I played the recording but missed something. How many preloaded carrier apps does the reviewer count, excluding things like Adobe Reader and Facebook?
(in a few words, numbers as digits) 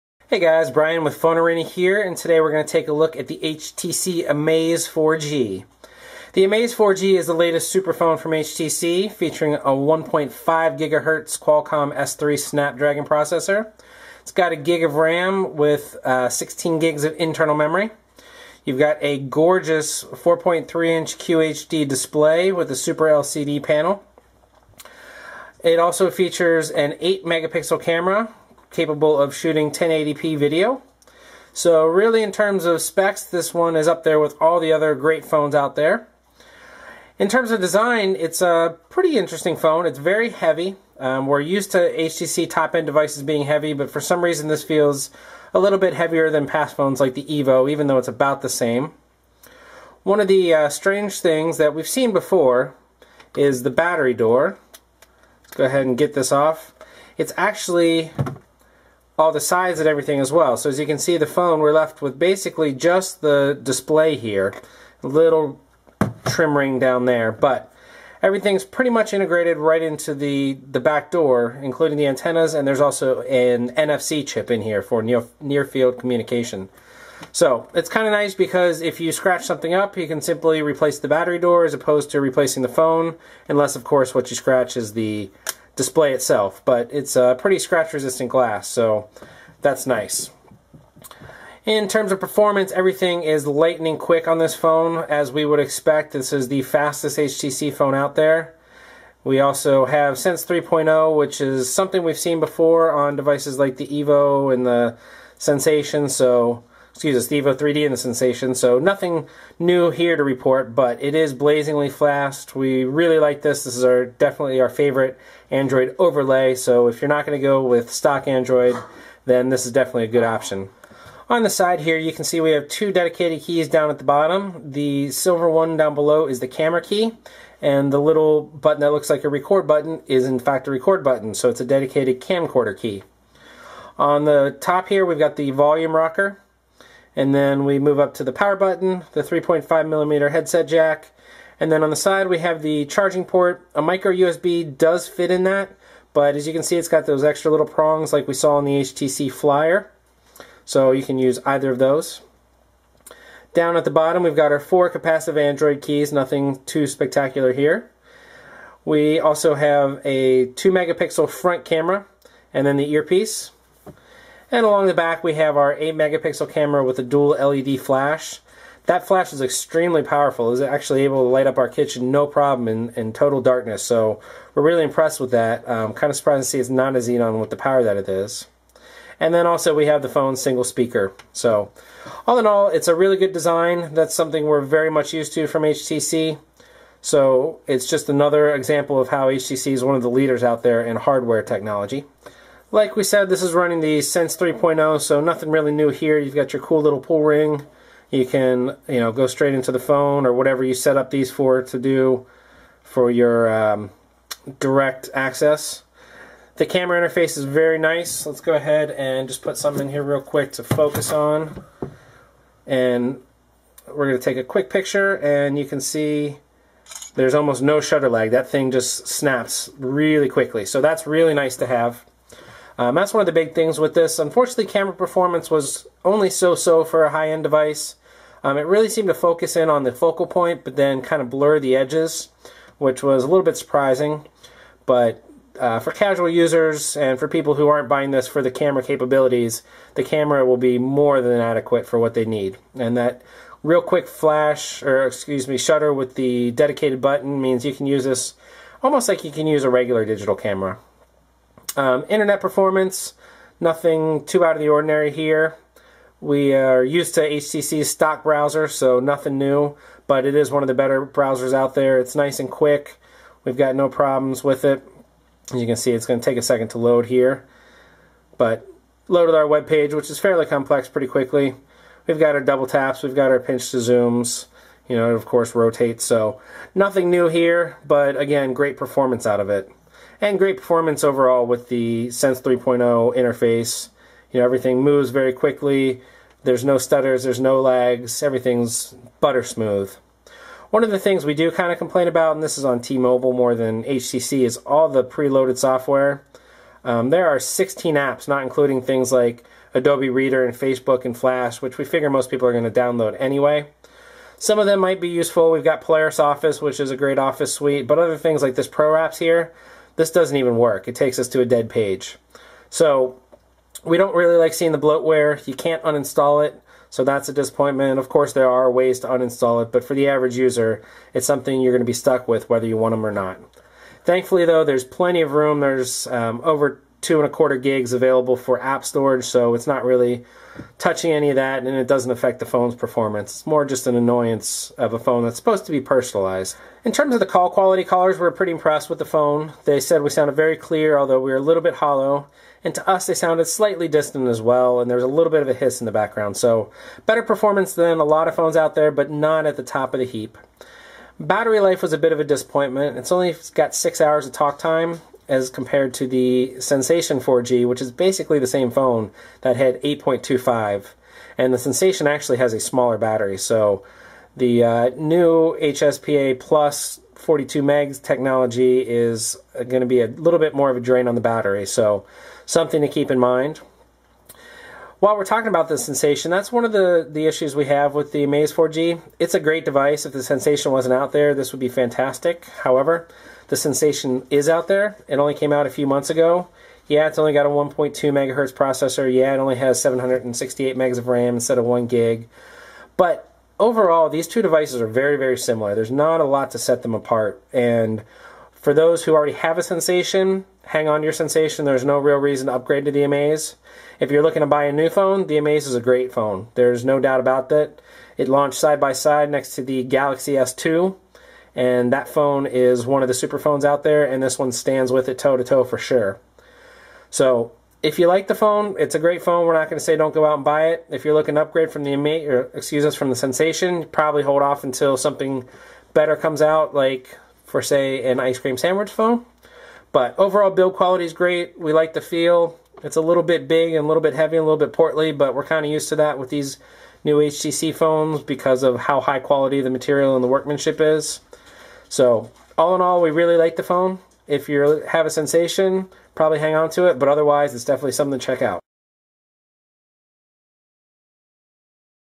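16.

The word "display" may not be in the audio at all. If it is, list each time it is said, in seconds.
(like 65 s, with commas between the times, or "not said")
21 s, 63 s, 85 s.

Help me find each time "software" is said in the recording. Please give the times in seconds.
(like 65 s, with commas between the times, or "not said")
295 s.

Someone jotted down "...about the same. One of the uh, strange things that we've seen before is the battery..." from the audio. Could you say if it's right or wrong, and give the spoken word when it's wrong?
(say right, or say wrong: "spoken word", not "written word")
right.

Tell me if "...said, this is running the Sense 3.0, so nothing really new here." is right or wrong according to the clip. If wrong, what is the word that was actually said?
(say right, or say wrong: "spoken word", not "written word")
right.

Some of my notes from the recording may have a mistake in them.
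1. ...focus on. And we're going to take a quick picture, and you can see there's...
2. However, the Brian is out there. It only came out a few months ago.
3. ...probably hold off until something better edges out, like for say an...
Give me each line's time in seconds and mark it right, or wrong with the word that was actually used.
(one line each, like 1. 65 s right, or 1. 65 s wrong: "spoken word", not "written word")
1. 210 s right
2. 382 s wrong: "Sensation", not "Brian"
3. 423 s wrong: "comes", not "edges".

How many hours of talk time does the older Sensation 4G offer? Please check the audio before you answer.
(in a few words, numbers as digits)
8.25.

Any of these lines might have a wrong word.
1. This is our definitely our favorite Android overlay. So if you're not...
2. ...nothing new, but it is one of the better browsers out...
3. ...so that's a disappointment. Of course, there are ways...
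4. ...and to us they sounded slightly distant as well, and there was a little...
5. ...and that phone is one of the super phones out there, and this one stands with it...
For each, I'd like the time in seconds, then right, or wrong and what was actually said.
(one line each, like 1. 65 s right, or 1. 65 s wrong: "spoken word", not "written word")
1. 113 s right
2. 258 s right
3. 316 s right
4. 342 s right
5. 411 s right.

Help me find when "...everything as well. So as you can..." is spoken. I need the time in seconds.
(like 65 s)
59 s.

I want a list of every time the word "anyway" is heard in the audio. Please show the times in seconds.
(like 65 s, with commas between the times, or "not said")
303 s.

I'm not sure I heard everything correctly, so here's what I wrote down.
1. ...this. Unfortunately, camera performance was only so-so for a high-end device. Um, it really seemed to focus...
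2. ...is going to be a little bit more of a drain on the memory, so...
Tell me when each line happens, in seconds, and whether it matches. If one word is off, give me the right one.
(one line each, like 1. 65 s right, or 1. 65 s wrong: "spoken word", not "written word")
1. 223 s right
2. 368 s wrong: "battery", not "memory".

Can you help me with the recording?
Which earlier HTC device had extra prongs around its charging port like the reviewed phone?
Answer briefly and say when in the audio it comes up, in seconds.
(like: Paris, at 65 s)
HTC Flyer, at 148 s.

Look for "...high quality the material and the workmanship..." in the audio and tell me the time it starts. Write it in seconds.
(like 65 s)
439 s.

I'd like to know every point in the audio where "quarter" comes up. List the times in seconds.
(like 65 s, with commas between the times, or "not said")
327 s.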